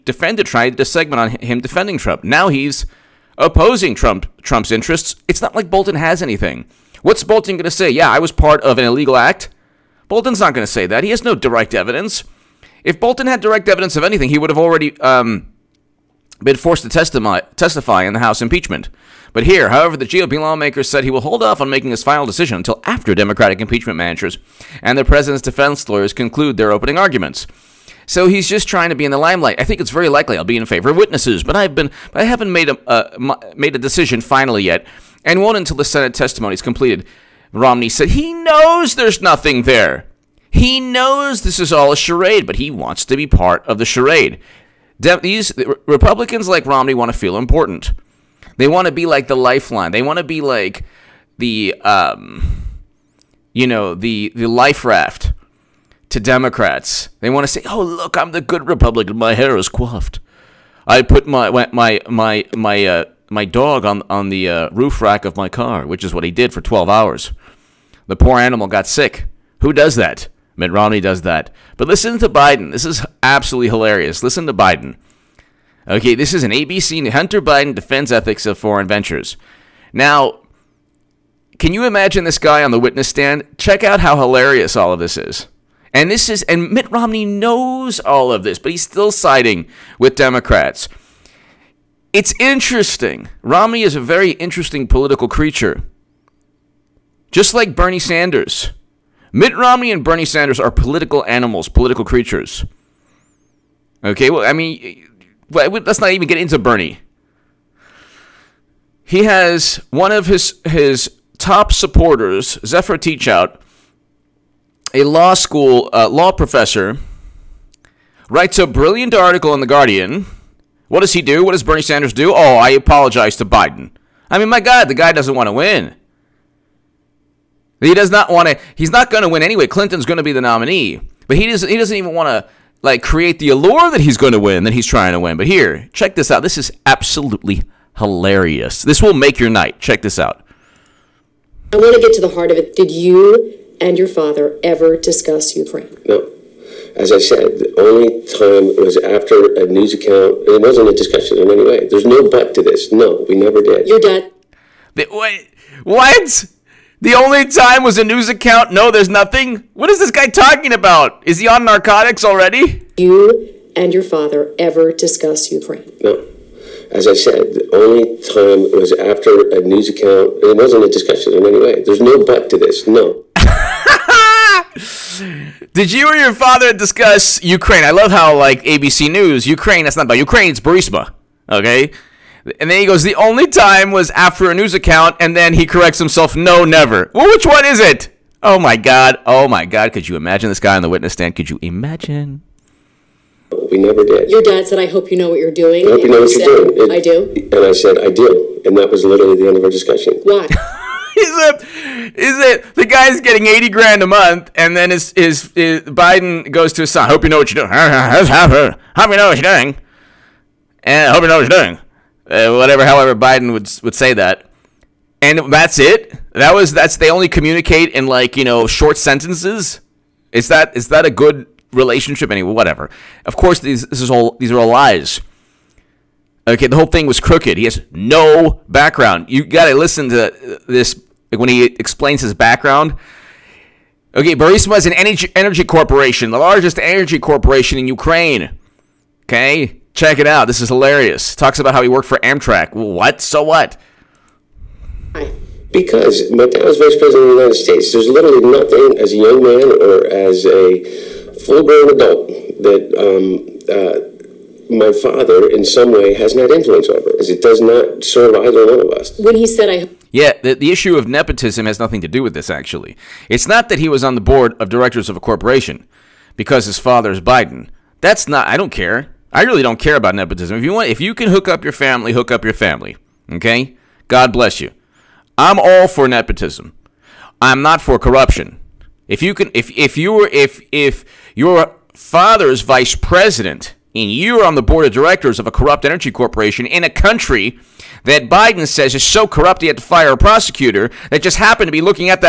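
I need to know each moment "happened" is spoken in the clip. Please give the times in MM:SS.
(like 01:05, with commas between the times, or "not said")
04:51.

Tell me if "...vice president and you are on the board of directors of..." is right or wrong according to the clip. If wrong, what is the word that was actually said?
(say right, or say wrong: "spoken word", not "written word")
right.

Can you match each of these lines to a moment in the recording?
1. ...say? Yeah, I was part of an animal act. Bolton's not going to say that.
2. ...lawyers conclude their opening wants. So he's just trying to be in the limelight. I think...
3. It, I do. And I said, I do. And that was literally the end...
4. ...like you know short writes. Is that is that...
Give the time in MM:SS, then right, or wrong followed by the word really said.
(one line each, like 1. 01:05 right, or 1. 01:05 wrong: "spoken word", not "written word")
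1. 00:07 wrong: "illegal", not "animal"
2. 00:25 wrong: "arguments", not "wants"
3. 03:16 right
4. 03:38 wrong: "sentences", not "writes".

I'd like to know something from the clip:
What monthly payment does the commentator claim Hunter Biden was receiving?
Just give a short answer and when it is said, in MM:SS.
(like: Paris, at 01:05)
80 grand, at 03:23.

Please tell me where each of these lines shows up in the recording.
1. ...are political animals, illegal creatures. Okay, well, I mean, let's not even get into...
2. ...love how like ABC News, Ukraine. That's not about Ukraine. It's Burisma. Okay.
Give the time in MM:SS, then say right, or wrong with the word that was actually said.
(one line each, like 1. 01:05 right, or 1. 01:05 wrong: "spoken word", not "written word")
1. 01:40 wrong: "political", not "illegal"
2. 02:57 right.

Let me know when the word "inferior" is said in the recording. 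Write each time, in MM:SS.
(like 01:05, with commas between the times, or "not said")
not said.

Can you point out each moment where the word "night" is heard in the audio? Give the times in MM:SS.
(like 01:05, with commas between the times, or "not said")
02:19.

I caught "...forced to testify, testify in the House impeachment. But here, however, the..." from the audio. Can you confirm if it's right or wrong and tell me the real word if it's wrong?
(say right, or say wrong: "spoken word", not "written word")
right.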